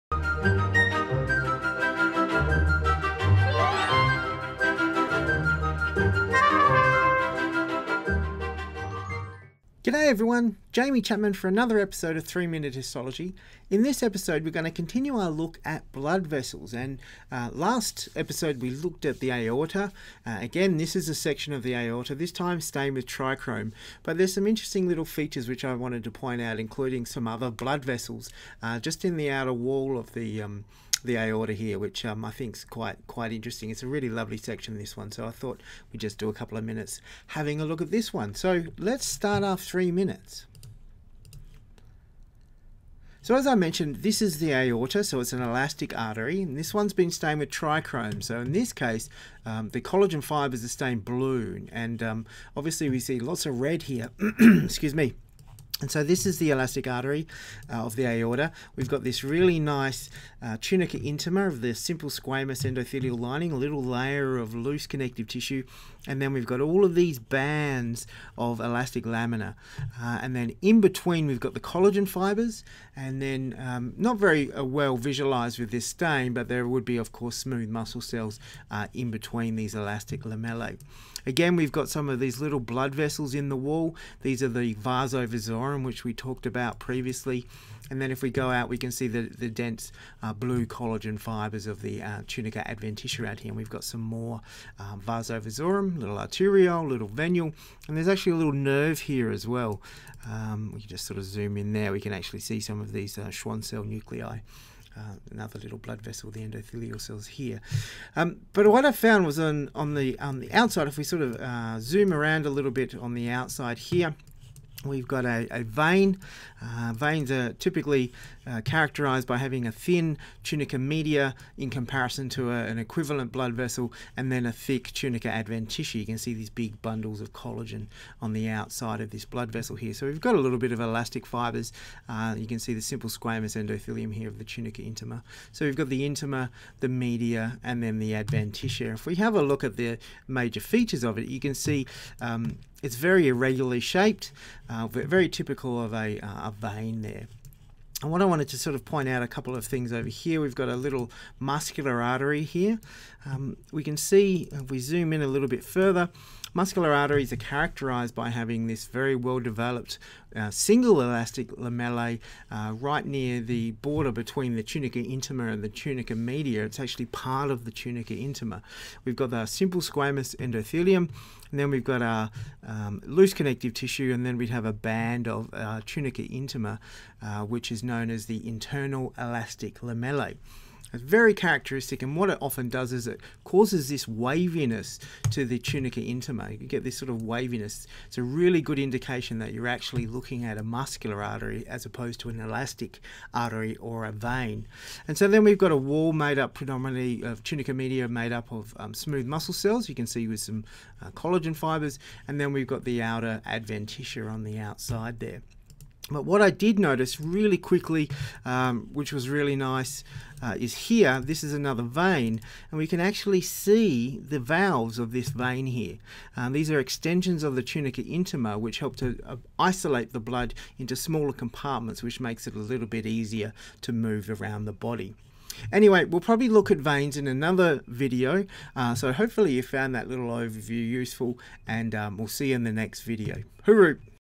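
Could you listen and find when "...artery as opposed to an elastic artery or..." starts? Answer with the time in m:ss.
3:11.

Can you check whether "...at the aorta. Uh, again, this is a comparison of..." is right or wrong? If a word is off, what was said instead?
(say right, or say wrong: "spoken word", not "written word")
wrong: "section", not "comparison".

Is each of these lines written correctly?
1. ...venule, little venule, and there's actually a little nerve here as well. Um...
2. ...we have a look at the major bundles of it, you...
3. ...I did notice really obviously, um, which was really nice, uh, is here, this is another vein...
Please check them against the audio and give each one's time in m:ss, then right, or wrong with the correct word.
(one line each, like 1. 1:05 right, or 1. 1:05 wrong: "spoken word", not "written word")
1. 1:36 wrong: "arteriole", not "venule"
2. 2:19 wrong: "features", not "bundles"
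3. 3:26 wrong: "quickly", not "obviously".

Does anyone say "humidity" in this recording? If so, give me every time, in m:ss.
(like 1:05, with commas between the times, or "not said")
not said.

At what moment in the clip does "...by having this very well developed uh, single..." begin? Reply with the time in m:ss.
2:38.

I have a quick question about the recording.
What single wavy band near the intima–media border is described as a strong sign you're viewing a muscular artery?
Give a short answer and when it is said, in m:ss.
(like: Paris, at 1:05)
Internal elastic lamellae, at 2:58.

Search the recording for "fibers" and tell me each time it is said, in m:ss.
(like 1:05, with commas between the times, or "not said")
0:50, 1:12, 1:31, 2:11, 3:21.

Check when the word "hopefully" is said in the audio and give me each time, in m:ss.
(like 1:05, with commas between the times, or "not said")
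3:49.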